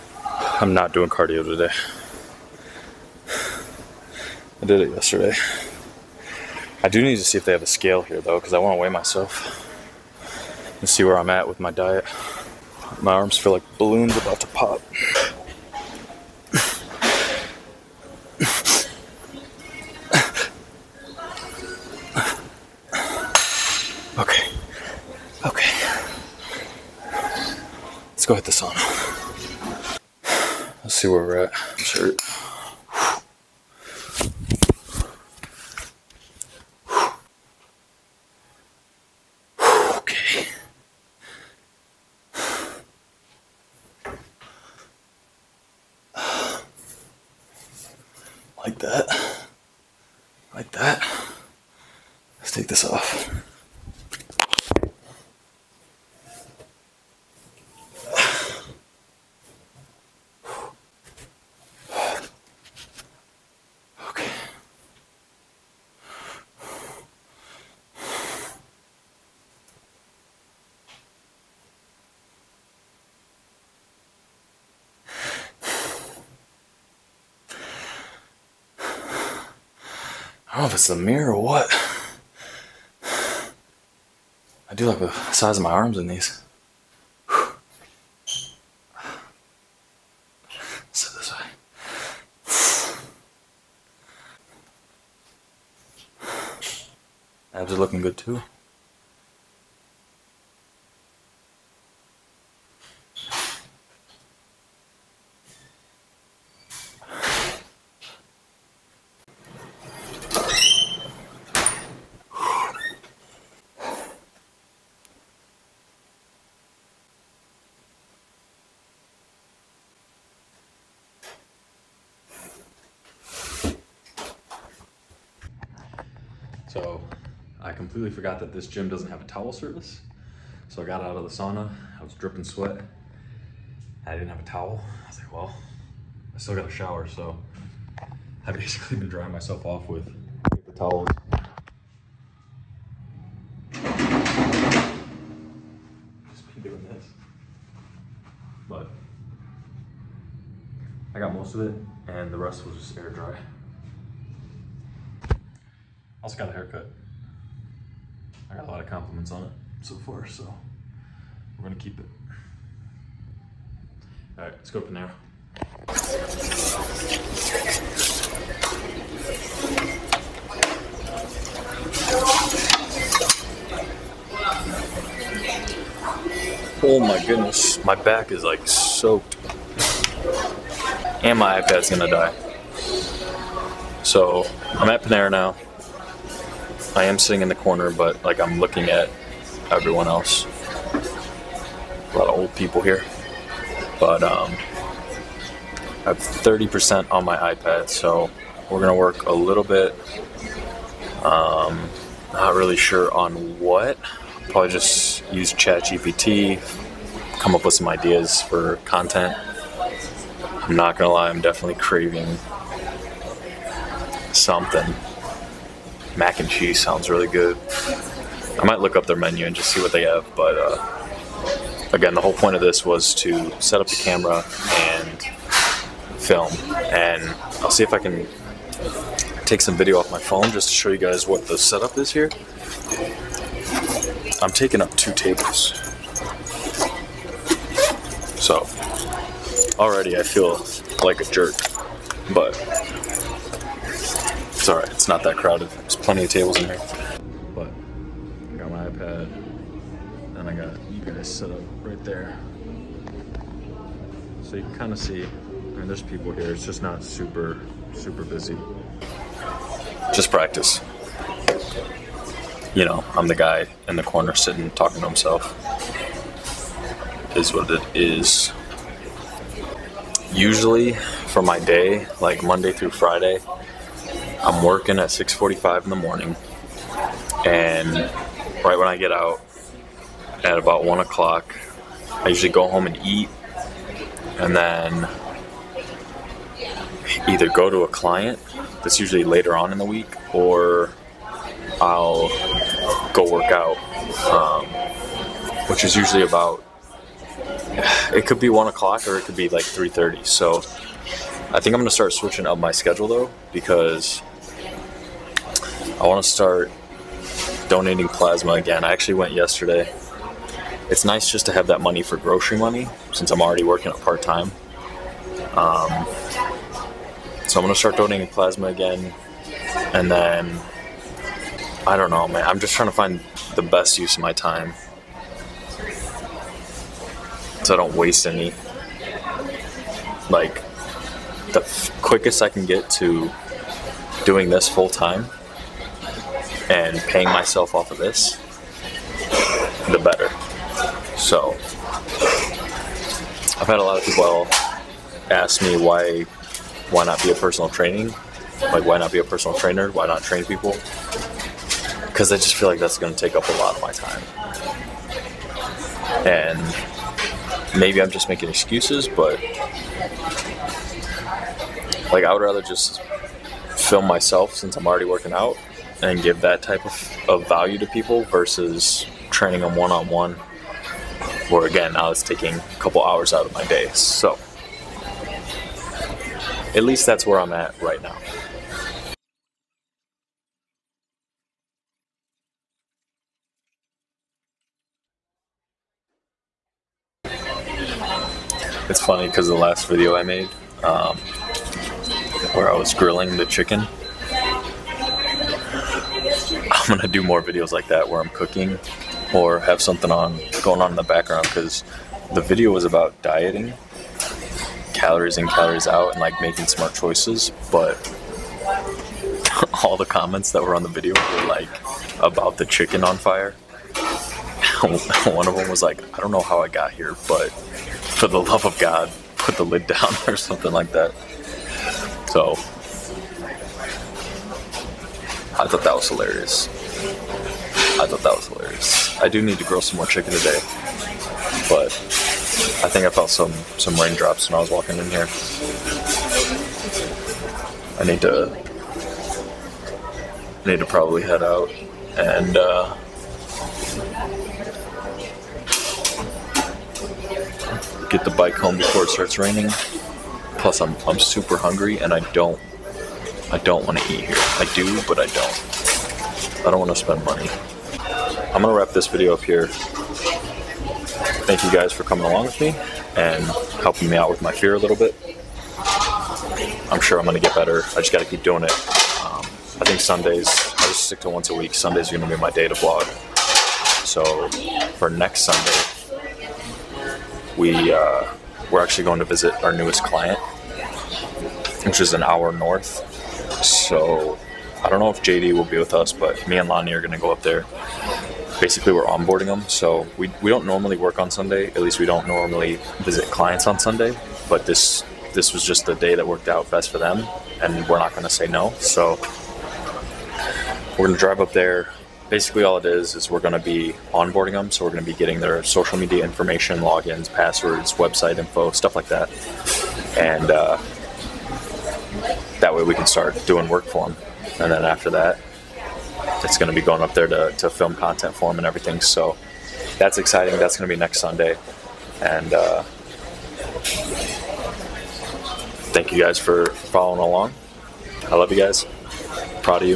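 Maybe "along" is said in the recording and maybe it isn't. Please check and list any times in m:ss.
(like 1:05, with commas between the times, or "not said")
7:42, 8:47.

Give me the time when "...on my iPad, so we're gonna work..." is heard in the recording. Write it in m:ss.
3:17.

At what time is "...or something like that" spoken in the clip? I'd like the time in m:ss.
7:00.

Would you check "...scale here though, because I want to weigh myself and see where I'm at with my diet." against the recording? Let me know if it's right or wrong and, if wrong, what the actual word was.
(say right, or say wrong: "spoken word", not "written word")
right.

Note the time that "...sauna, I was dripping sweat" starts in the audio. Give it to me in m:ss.
2:11.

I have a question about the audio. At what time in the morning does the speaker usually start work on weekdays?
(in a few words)
6:45.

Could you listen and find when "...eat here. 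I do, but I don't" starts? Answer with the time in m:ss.
7:34.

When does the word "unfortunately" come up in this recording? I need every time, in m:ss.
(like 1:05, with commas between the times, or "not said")
not said.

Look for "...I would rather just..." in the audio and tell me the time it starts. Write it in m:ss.
6:02.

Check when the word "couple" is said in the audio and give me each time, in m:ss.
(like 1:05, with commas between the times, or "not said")
6:12.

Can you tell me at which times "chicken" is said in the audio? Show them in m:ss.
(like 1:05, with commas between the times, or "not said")
6:33, 6:52, 7:10.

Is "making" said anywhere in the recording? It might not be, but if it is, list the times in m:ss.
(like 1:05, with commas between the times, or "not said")
5:58, 6:46.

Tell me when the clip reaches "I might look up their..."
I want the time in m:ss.
3:38.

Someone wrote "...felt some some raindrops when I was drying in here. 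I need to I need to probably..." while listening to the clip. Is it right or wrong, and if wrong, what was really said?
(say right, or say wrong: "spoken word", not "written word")
wrong: "walking", not "drying".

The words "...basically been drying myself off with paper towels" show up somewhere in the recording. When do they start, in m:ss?
2:18.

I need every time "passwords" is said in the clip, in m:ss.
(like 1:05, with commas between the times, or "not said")
8:27.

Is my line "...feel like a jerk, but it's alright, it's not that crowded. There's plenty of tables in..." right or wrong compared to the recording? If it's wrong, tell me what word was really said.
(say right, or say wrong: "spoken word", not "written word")
right.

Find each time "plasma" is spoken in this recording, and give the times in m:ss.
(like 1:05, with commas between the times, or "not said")
5:08, 5:18.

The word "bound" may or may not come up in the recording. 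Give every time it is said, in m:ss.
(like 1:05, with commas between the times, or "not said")
not said.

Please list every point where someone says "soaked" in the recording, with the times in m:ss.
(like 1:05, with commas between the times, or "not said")
2:58.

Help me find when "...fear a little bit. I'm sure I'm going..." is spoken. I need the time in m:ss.
7:44.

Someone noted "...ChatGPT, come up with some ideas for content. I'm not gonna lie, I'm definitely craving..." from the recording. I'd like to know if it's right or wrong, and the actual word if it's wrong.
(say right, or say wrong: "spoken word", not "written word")
right.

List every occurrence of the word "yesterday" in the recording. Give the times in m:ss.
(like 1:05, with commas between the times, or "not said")
0:04, 5:09.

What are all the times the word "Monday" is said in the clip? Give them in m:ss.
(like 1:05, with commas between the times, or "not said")
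4:32.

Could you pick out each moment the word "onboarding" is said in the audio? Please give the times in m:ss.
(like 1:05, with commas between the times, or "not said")
8:09, 8:24.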